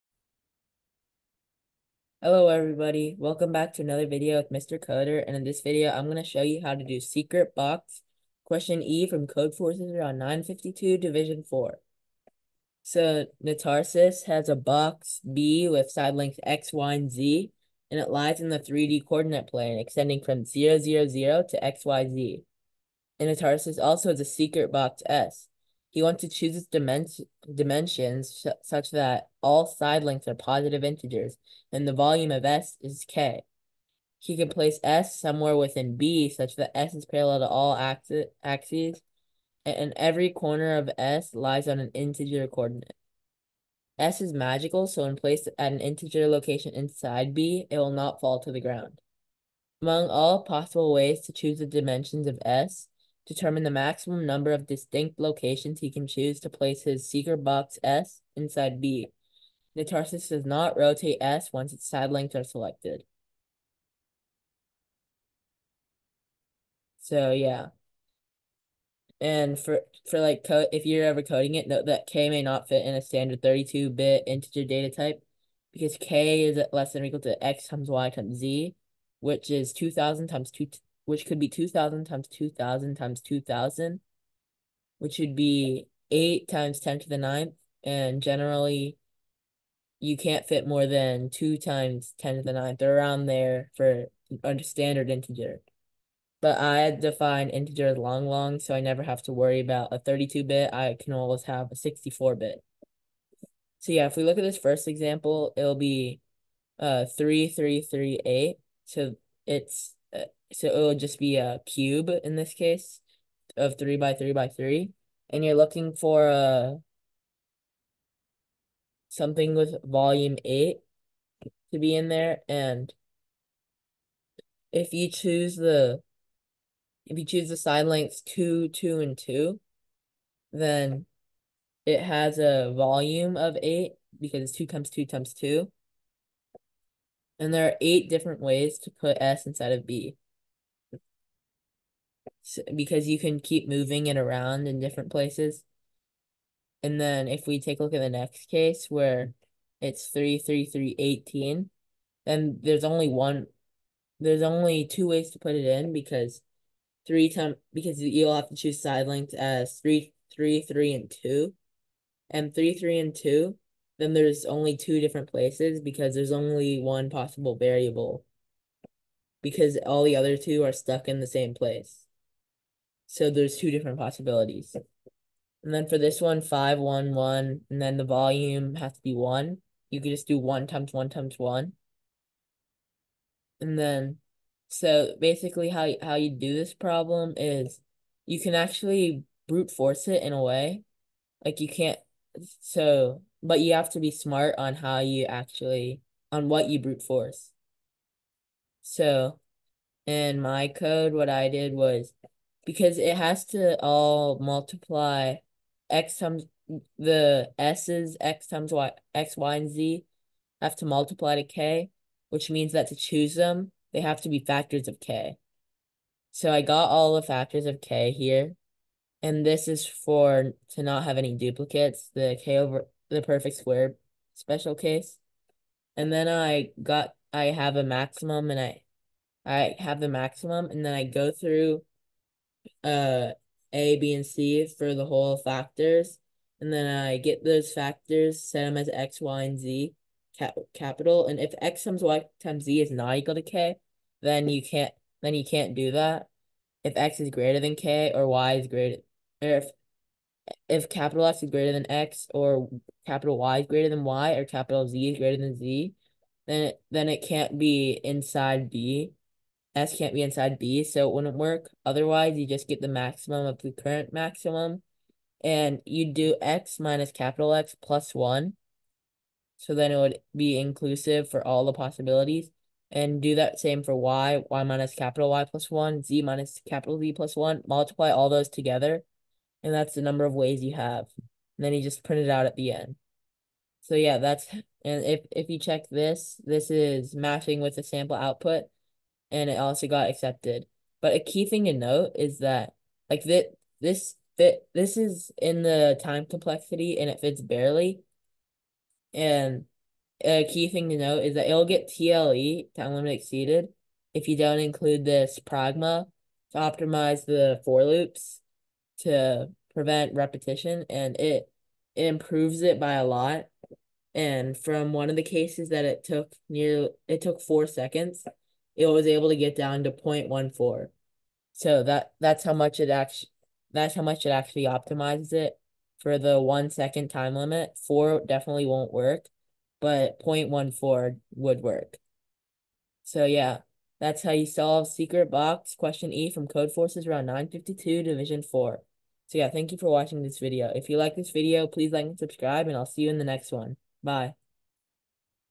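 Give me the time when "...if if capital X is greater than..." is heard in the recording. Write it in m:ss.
4:09.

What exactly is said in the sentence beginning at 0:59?
Ntarsis does not rotate S once its side lengths are selected.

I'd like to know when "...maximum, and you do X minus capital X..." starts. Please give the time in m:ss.
4:24.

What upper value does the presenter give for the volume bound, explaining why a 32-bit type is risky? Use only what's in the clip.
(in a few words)
8 times 10 to the ninth.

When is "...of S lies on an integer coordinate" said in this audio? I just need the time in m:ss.
0:40.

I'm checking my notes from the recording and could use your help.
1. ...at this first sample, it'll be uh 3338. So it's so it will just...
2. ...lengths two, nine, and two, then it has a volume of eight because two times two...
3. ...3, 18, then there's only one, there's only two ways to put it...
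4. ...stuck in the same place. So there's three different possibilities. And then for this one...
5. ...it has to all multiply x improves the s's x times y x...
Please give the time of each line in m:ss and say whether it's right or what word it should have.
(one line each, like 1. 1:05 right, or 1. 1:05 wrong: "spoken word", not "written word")
1. 1:44 wrong: "example", not "sample"
2. 2:07 wrong: "two", not "nine"
3. 2:30 right
4. 2:50 wrong: "two", not "three"
5. 3:22 wrong: "times", not "improves".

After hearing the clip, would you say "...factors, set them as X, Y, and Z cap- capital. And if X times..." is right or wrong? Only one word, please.
right.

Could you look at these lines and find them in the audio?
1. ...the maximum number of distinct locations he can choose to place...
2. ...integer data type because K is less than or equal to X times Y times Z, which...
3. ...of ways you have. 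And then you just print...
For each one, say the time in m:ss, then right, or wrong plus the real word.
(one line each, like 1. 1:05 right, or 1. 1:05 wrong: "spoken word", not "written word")
1. 0:53 right
2. 1:14 right
3. 4:40 right.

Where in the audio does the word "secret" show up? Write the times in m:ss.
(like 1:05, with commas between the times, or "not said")
0:06, 0:24, 5:34.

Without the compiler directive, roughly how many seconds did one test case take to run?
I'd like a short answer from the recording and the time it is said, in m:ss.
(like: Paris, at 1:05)
4, at 5:17.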